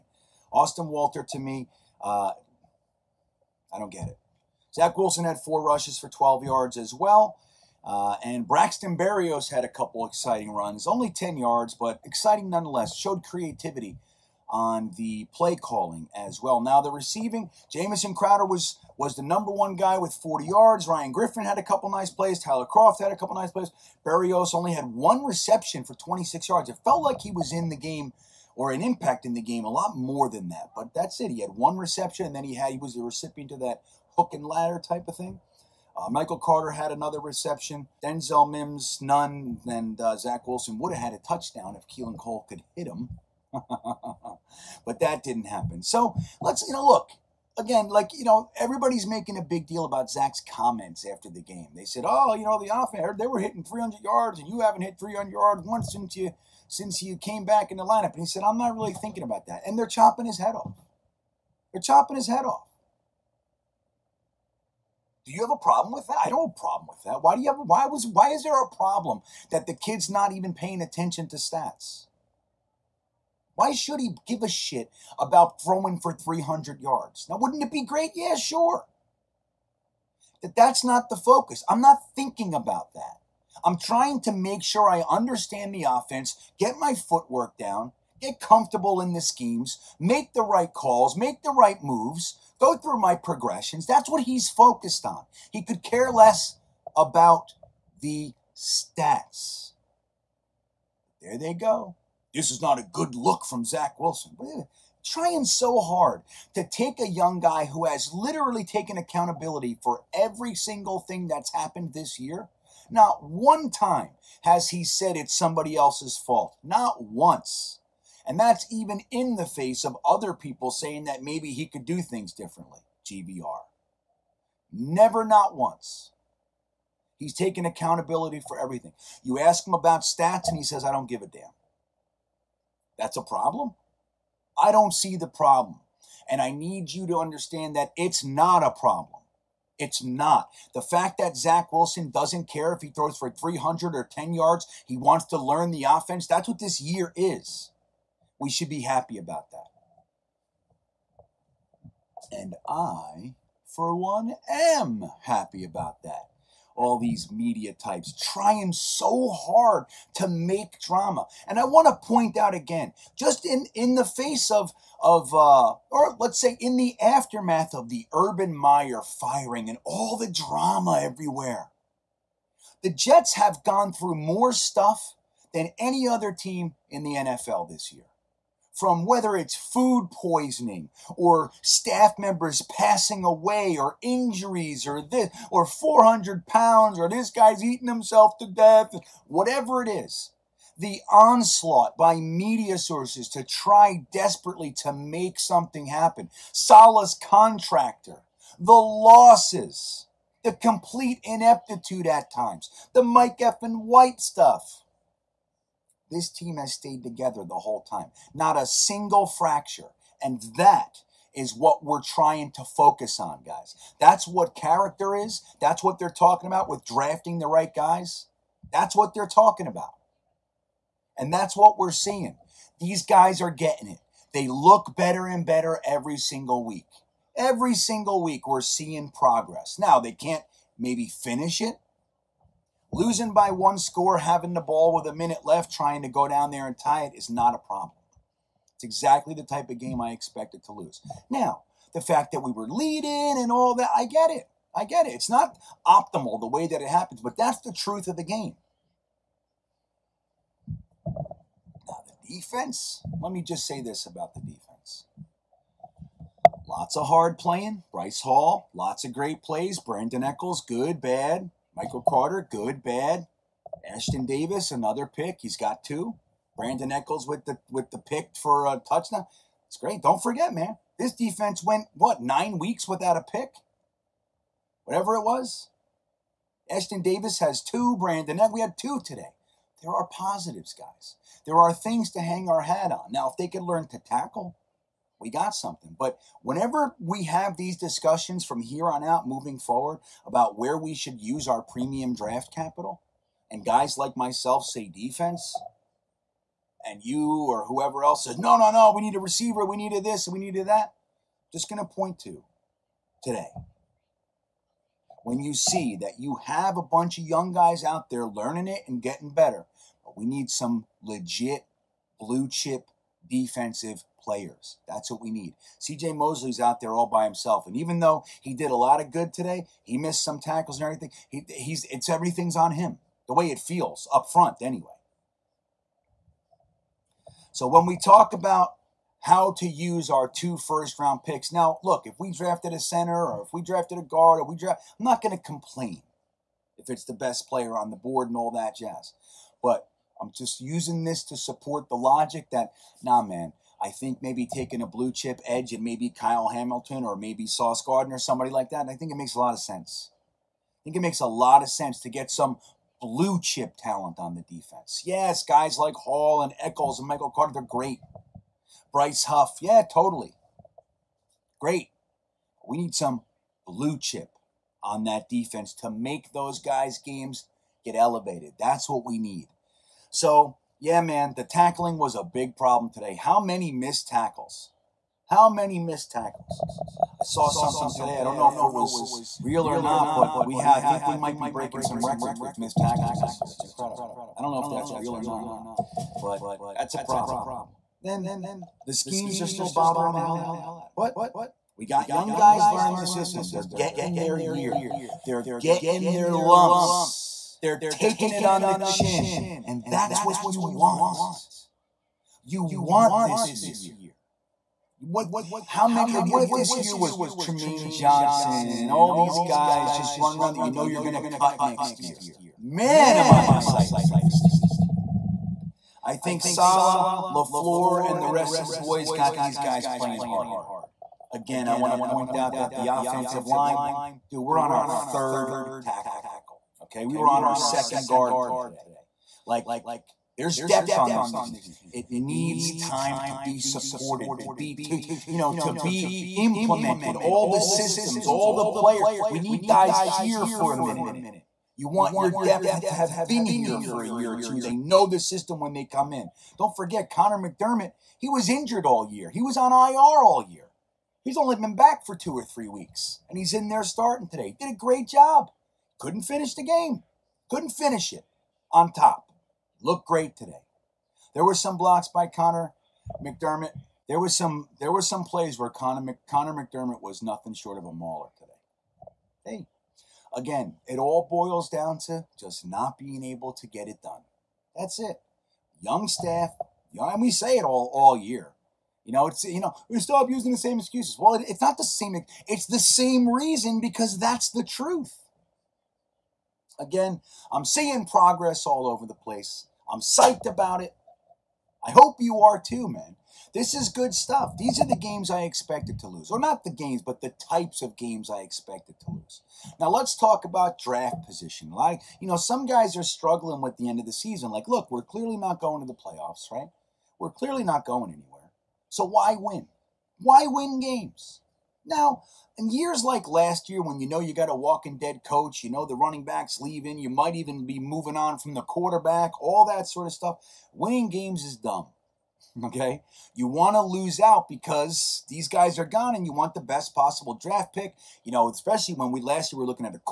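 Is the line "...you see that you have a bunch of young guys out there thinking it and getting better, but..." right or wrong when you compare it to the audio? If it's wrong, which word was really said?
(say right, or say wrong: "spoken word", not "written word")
wrong: "learning", not "thinking".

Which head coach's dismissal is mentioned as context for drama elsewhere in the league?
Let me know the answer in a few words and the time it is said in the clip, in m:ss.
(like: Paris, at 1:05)
Urban Meyer, at 2:48.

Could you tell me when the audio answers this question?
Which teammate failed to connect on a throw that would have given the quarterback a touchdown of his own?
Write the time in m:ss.
0:41.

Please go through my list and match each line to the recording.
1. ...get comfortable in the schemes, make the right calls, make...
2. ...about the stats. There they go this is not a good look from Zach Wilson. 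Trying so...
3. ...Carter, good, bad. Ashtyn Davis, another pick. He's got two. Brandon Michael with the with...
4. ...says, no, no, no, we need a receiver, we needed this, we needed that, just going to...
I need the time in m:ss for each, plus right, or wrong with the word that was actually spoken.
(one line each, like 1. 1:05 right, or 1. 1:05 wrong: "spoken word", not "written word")
1. 1:28 right
2. 1:36 right
3. 4:22 wrong: "Echols", not "Michael"
4. 4:58 right.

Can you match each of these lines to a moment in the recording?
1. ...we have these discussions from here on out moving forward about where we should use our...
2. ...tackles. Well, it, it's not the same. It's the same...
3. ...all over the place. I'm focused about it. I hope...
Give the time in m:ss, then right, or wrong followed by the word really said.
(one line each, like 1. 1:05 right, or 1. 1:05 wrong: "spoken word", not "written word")
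1. 4:46 right
2. 8:00 wrong: "excuses", not "tackles"
3. 8:08 wrong: "psyched", not "focused".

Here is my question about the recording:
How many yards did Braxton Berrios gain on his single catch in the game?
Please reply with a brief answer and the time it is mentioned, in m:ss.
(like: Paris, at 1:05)
26, at 0:25.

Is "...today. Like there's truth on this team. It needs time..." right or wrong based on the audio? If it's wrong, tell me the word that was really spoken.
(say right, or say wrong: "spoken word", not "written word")
wrong: "depth", not "truth".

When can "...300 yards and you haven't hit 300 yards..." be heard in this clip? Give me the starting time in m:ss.
0:53.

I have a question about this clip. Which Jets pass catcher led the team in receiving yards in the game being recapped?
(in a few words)
Jamison Crowder.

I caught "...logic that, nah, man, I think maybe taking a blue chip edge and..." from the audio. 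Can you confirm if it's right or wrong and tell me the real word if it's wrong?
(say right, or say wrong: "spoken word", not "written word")
right.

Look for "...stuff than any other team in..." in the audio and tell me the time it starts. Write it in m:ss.
2:54.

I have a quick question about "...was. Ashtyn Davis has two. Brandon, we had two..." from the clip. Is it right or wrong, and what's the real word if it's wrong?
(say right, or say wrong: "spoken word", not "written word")
right.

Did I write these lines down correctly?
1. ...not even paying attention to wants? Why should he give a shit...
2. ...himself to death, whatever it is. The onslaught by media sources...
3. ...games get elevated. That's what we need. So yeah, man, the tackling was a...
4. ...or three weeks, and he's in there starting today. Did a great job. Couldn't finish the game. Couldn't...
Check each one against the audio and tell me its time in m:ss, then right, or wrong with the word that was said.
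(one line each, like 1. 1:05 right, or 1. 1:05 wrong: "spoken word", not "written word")
1. 1:10 wrong: "stats", not "wants"
2. 3:07 right
3. 6:07 right
4. 7:32 right.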